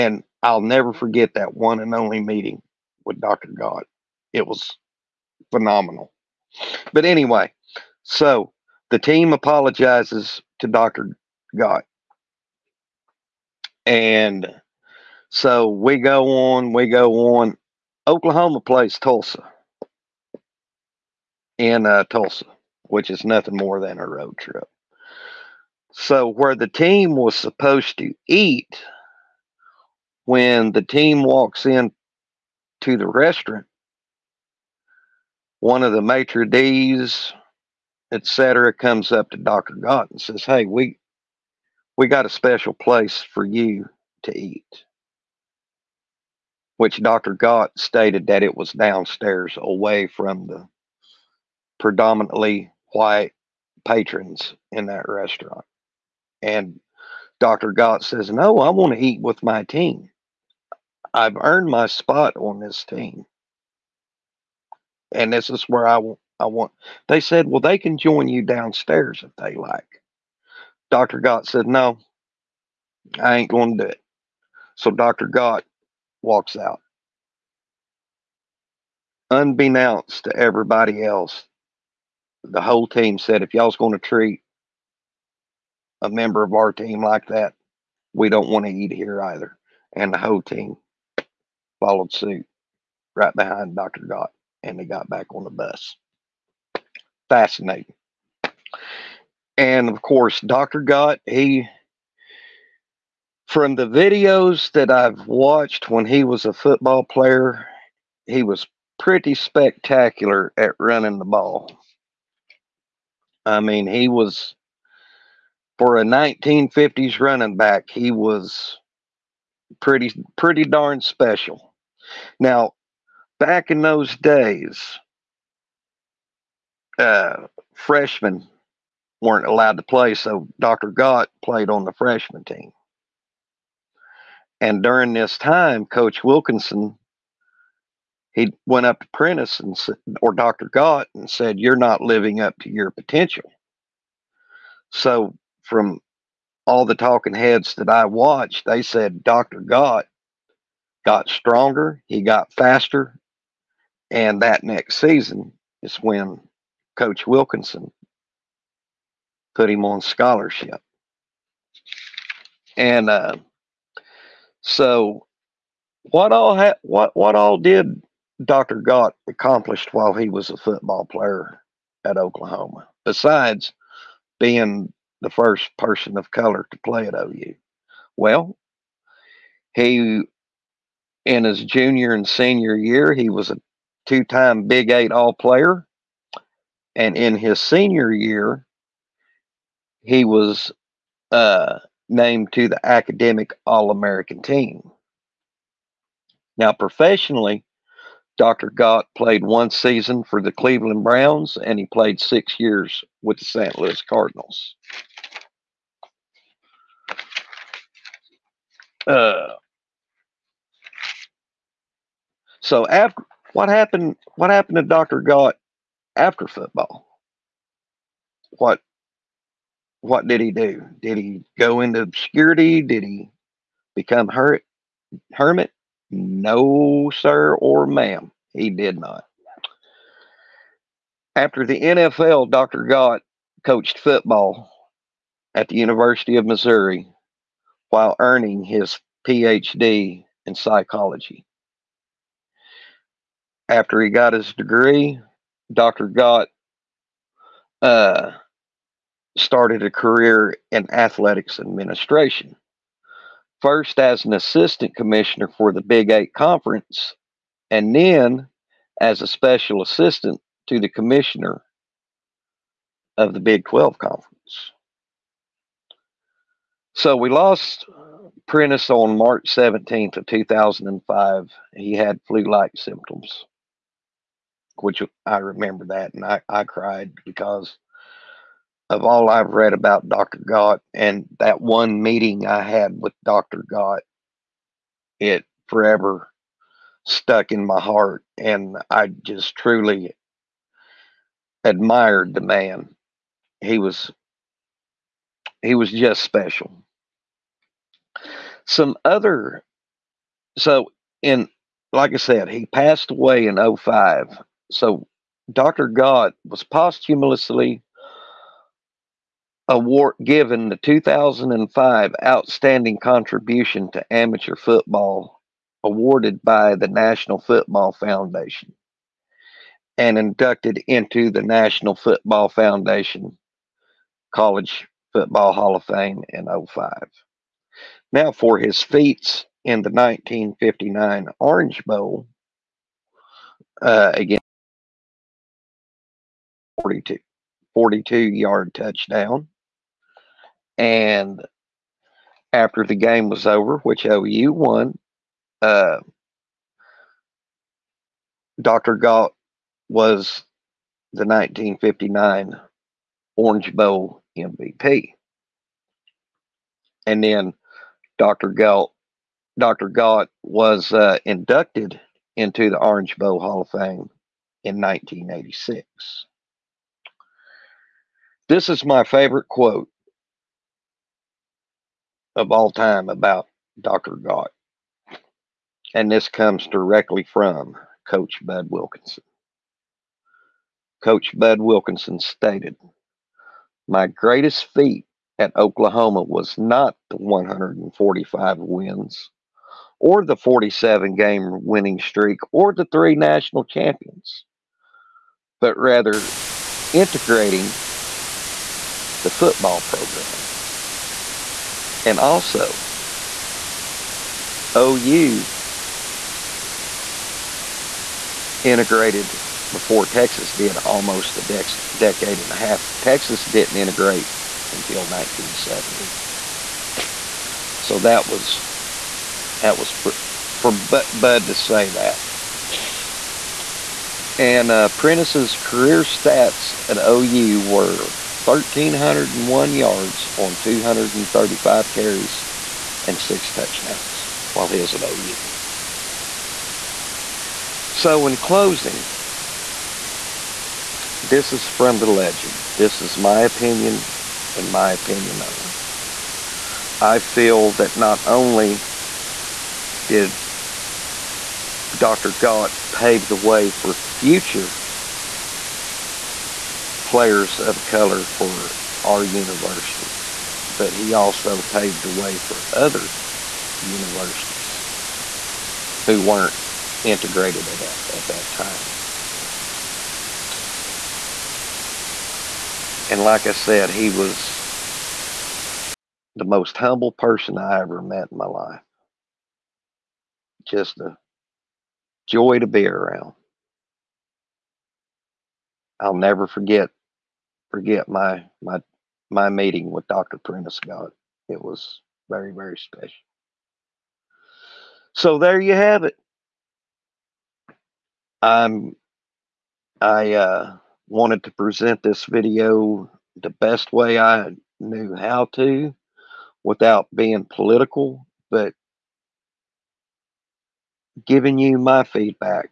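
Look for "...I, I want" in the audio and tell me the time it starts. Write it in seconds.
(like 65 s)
65 s.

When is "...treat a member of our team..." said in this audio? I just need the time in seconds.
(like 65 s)
83 s.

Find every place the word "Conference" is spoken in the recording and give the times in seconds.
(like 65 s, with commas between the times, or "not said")
256 s, 263 s.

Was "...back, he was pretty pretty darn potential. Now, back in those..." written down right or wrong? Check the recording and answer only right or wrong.
wrong.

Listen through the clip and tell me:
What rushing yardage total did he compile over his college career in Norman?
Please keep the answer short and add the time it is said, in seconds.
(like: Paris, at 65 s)
1,301 yards, at 428 s.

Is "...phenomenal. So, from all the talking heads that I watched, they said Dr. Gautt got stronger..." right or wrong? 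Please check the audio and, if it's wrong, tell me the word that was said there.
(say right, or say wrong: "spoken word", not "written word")
wrong: "potential", not "phenomenal".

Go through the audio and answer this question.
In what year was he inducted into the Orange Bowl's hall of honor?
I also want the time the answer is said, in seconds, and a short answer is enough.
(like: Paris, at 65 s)
1986, at 364 s.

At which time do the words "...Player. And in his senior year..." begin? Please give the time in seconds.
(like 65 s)
185 s.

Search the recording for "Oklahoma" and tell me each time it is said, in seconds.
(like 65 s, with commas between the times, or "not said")
18 s, 172 s, 385 s.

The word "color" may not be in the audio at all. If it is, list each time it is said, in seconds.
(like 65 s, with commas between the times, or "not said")
176 s, 457 s.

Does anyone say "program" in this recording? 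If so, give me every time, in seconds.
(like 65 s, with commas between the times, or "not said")
399 s.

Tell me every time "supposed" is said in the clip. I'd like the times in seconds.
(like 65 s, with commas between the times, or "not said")
27 s.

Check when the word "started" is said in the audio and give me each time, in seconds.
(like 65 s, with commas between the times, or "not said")
249 s.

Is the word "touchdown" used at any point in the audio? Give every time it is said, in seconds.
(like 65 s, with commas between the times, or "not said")
338 s, 433 s.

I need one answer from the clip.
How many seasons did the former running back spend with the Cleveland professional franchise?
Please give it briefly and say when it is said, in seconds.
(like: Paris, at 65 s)
one season, at 199 s.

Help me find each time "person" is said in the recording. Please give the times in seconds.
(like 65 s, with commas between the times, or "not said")
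175 s, 477 s.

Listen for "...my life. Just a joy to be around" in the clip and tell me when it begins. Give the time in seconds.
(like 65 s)
478 s.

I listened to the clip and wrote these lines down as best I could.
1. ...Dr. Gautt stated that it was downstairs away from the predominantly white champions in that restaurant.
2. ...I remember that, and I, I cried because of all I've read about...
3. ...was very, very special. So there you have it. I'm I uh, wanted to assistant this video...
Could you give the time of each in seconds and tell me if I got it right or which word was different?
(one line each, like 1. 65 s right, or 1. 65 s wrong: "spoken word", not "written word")
1. 47 s wrong: "patrons", not "champions"
2. 275 s right
3. 491 s wrong: "present", not "assistant".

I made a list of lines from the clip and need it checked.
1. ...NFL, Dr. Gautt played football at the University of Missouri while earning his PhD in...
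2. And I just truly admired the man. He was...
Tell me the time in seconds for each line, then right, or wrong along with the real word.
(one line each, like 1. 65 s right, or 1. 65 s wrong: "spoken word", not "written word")
1. 231 s wrong: "coached", not "played"
2. 288 s right.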